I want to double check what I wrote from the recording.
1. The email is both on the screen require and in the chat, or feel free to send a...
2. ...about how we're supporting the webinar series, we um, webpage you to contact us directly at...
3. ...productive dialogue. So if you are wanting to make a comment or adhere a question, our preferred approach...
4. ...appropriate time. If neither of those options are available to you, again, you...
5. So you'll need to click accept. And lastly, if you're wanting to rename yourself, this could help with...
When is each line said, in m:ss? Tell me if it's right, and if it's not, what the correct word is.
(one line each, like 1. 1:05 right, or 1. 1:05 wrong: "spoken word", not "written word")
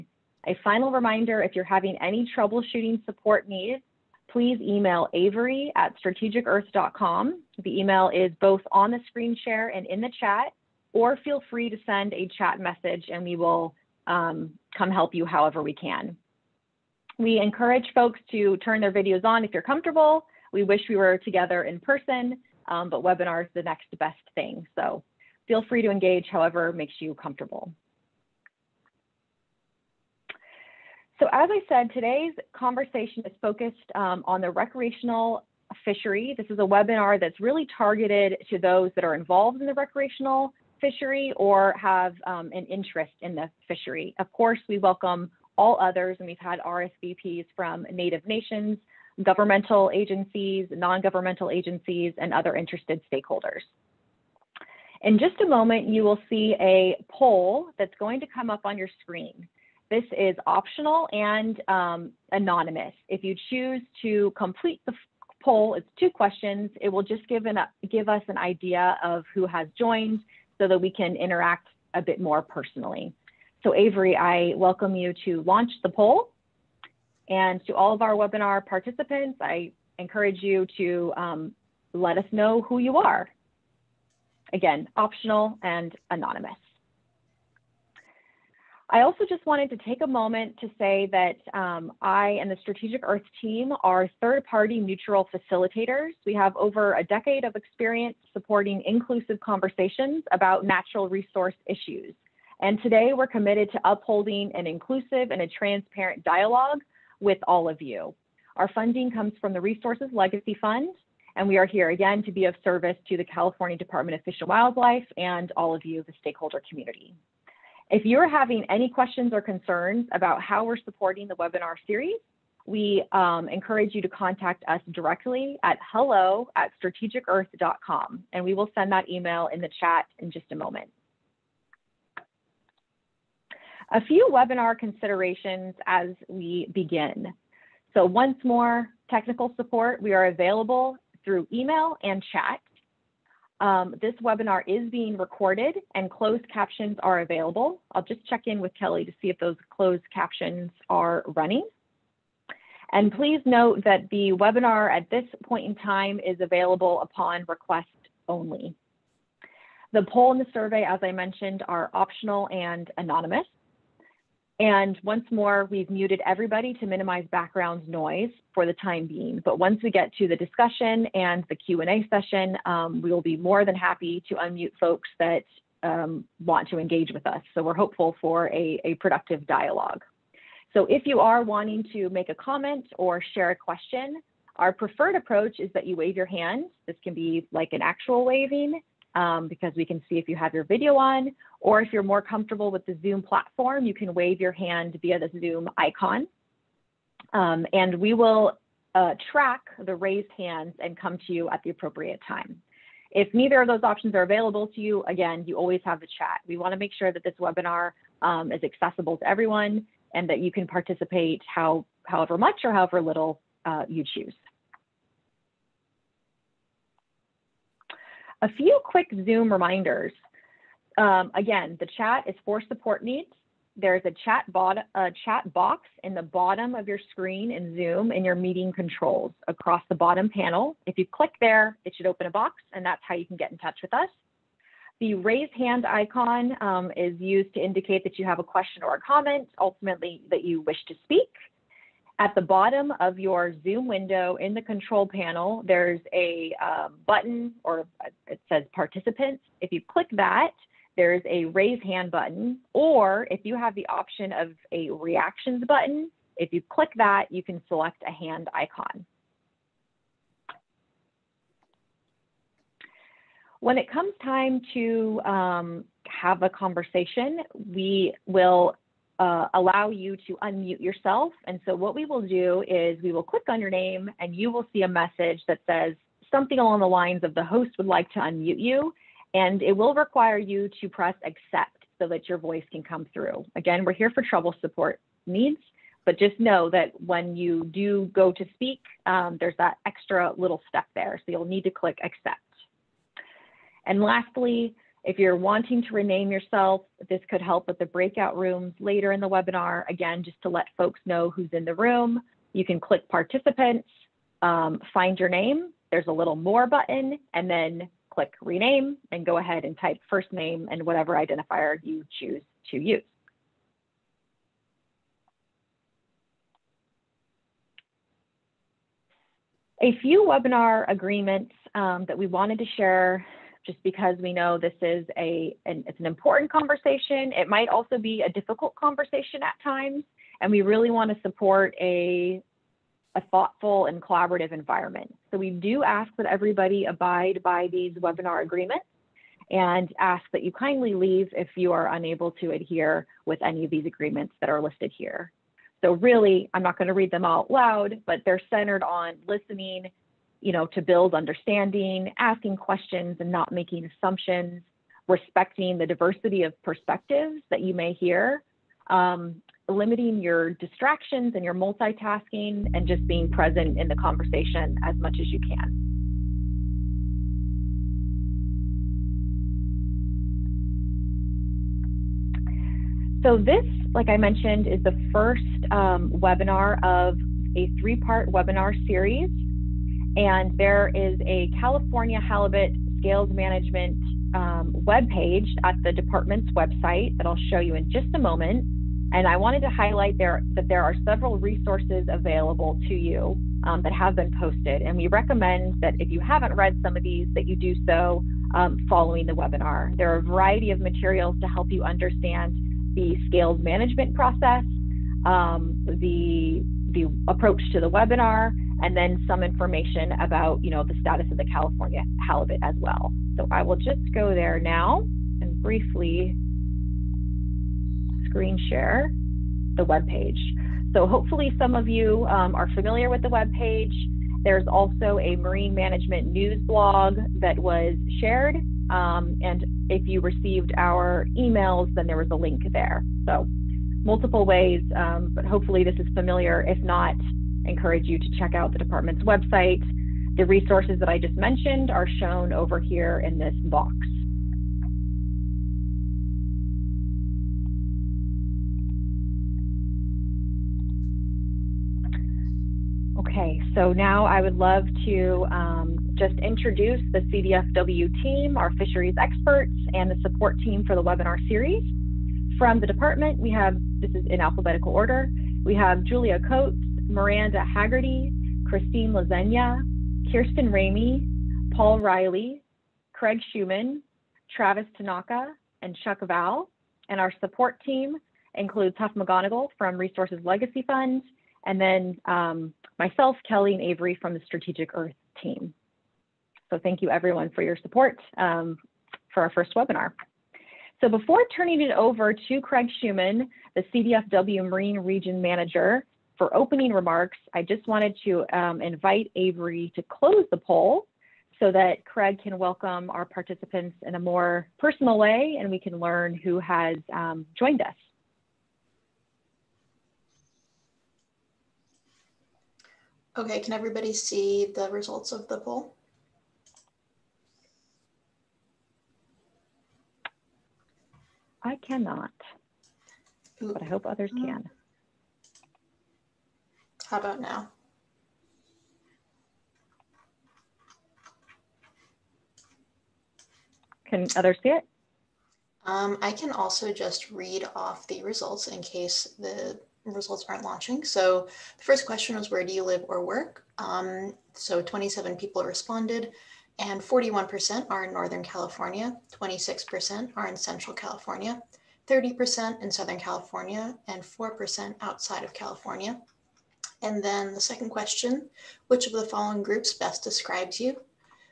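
1. 0:07 wrong: "share", not "require"
2. 2:00 wrong: "encourage", not "webpage"
3. 2:58 wrong: "share", not "adhere"
4. 3:21 right
5. 4:51 right.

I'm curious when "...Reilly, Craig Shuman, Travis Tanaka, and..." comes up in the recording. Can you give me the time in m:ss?
7:51.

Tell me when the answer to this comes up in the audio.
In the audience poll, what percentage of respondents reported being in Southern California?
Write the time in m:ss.
9:12.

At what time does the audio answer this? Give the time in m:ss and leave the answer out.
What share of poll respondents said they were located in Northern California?
9:06.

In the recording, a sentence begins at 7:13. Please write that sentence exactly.
So multiple ways, um, but hopefully this is familiar.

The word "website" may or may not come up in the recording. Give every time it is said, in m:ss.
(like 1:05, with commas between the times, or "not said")
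6:26, 7:19.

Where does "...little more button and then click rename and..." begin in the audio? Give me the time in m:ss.
5:06.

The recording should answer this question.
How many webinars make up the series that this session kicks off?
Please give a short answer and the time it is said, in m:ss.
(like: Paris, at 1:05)
3, at 6:17.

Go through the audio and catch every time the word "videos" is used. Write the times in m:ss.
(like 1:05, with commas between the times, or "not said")
0:18, 3:10.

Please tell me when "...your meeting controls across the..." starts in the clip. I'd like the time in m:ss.
3:48.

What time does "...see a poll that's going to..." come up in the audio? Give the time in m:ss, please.
0:56.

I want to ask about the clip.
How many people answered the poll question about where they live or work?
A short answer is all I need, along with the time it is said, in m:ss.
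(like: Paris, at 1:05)
27, at 9:04.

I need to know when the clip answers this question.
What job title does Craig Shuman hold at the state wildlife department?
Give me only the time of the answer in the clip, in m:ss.
8:14.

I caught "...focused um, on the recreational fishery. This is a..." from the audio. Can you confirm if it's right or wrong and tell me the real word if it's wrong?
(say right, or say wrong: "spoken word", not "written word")
right.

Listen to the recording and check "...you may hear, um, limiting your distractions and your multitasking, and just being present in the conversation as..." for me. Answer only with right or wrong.
right.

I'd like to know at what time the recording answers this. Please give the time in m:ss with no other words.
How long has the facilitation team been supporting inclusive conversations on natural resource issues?
1:36.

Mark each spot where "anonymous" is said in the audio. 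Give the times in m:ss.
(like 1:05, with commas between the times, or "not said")
1:02, 1:26, 2:42.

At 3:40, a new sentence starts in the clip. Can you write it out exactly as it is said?
Um, again, the chat is for support needs.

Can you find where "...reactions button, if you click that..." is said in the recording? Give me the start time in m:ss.
4:14.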